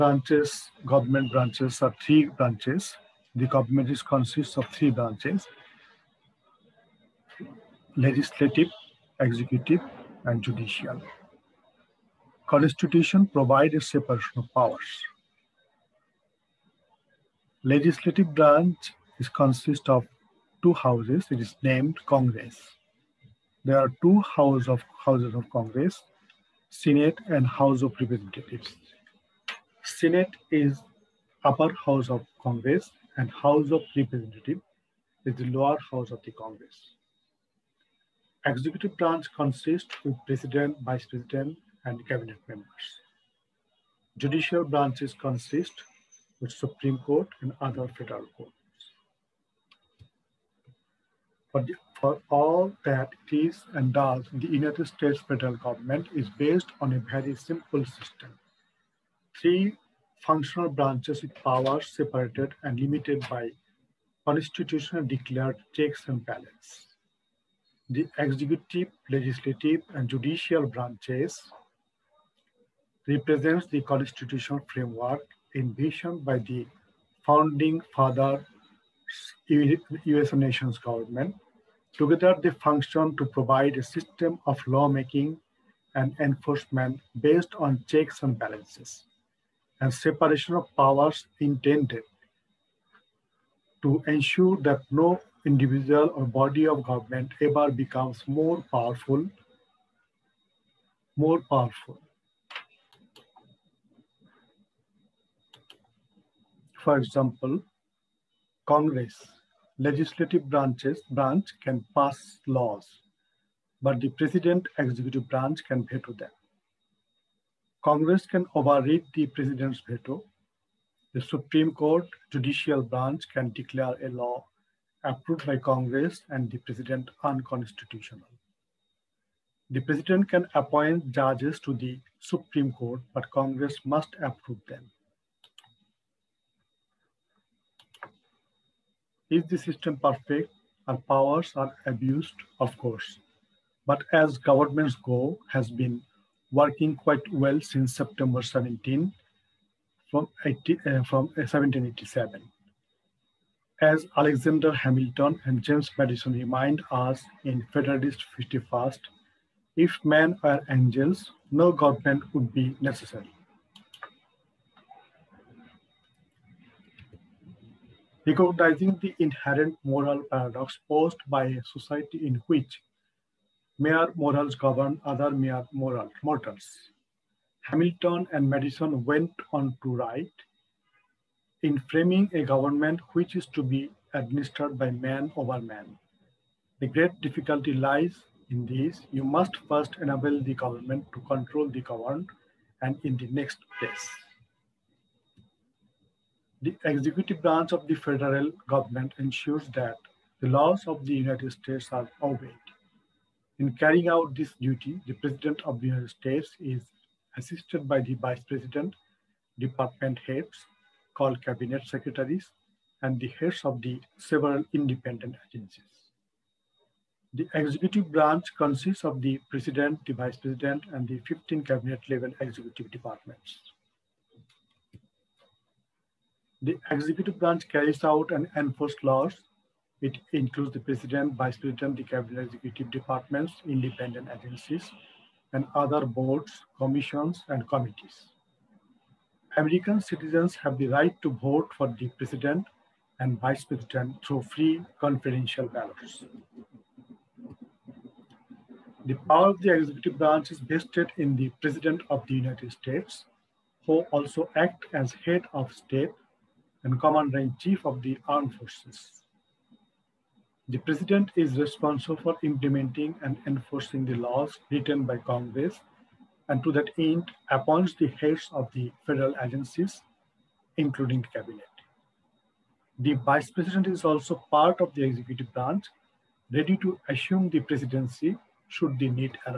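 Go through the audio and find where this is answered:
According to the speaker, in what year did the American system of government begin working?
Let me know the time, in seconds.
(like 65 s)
151 s.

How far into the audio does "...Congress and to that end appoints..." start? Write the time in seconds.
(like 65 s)
265 s.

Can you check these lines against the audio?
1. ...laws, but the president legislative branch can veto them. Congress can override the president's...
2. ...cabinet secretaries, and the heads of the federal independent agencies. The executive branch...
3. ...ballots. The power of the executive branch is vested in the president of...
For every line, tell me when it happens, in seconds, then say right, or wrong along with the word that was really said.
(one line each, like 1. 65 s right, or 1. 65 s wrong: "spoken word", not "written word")
1. 112 s wrong: "executive", not "legislative"
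2. 211 s wrong: "several", not "federal"
3. 245 s right.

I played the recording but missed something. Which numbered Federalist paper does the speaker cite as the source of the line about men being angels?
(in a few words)
Federalist 51.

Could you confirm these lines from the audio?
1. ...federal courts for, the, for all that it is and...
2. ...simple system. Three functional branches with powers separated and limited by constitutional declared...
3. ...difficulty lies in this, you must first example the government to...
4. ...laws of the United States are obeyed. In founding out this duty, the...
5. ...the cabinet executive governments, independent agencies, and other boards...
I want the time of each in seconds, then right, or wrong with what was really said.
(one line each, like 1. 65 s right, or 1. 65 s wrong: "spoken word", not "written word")
1. 47 s right
2. 57 s right
3. 187 s wrong: "enable", not "example"
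4. 200 s wrong: "carrying", not "founding"
5. 231 s wrong: "departments", not "governments".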